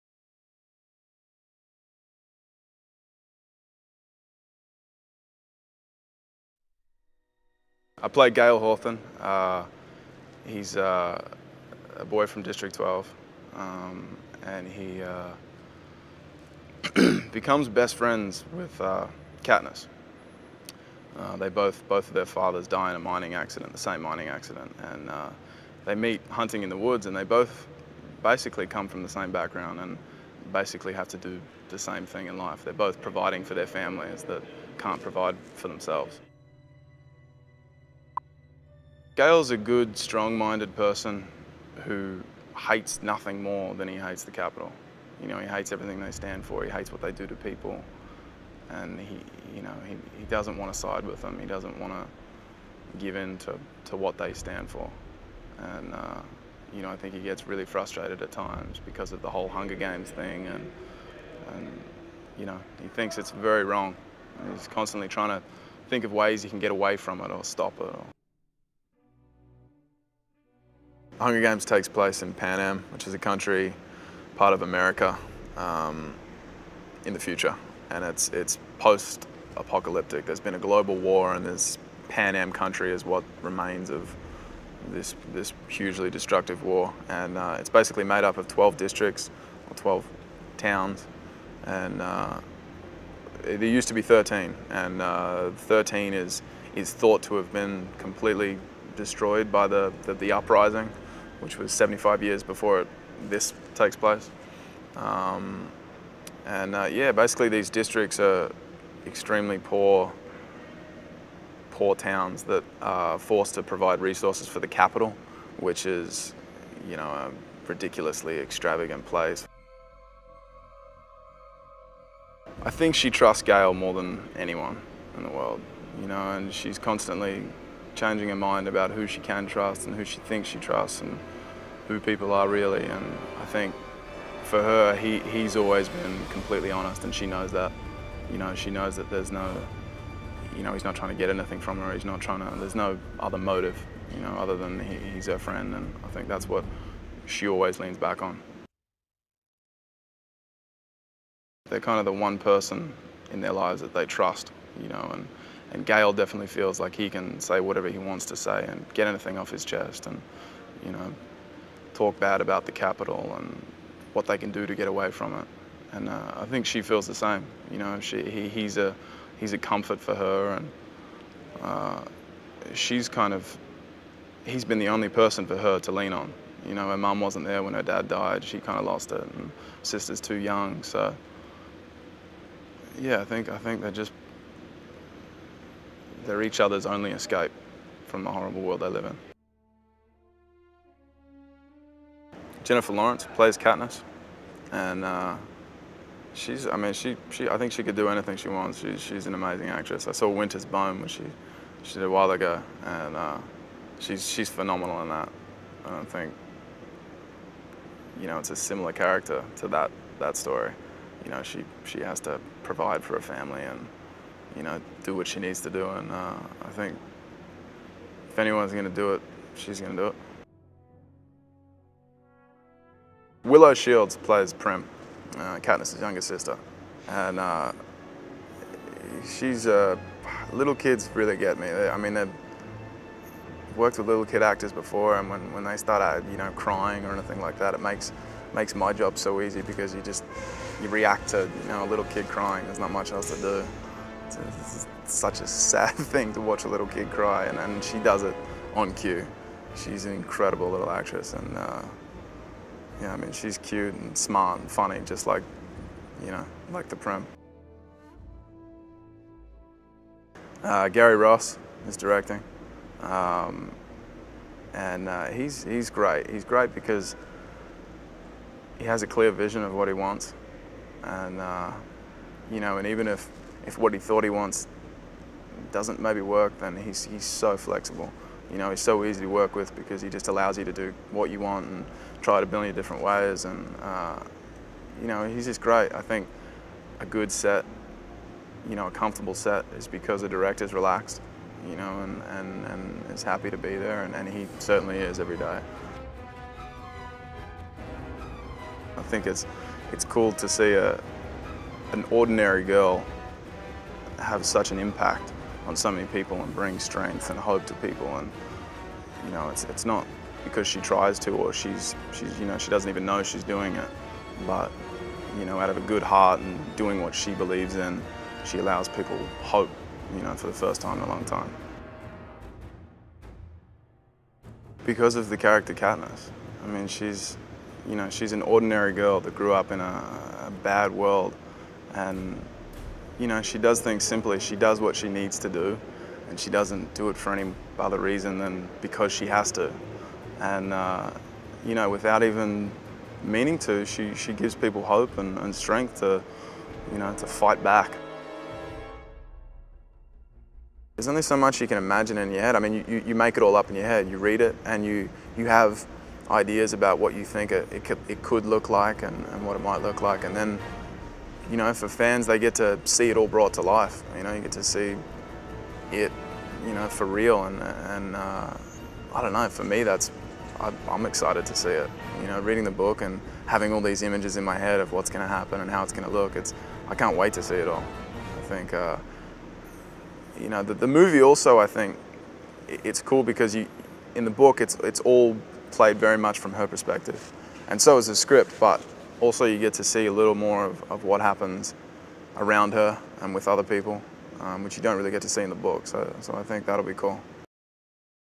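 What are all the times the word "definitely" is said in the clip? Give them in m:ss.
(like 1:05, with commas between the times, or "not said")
2:36.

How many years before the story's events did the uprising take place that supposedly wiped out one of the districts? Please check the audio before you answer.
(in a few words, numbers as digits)
75.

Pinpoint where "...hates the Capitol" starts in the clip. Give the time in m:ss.
0:43.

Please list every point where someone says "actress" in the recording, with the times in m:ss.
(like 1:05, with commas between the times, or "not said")
3:19, 4:10.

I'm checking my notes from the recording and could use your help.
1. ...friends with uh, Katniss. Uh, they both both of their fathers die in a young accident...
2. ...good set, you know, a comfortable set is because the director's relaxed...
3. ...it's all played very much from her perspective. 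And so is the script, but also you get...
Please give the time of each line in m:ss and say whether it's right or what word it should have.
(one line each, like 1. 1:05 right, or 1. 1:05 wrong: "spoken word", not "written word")
1. 0:17 wrong: "mining", not "young"
2. 4:47 right
3. 6:24 right.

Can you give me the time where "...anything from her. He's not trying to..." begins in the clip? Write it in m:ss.
2:21.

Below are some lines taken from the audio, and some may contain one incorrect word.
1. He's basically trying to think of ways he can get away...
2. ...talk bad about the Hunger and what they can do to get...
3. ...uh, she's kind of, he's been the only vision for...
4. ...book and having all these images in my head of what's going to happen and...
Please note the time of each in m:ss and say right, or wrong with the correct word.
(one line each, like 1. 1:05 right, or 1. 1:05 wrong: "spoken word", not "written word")
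1. 1:04 wrong: "constantly", not "basically"
2. 2:41 wrong: "Capitol", not "Hunger"
3. 2:51 wrong: "person", not "vision"
4. 6:12 right.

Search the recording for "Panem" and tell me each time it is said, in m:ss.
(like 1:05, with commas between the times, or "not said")
1:12, 1:22.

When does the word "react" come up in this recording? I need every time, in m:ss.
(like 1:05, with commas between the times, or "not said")
4:00.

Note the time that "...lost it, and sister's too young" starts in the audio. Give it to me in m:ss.
2:58.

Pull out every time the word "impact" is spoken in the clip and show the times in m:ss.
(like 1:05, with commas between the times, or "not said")
5:04.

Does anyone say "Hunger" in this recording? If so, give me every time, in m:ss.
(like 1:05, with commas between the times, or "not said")
0:59, 1:11.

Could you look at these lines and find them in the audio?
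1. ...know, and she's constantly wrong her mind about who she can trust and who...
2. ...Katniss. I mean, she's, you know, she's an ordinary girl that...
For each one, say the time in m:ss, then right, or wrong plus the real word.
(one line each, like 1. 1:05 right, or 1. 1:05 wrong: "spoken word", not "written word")
1. 2:06 wrong: "changing", not "wrong"
2. 5:25 right.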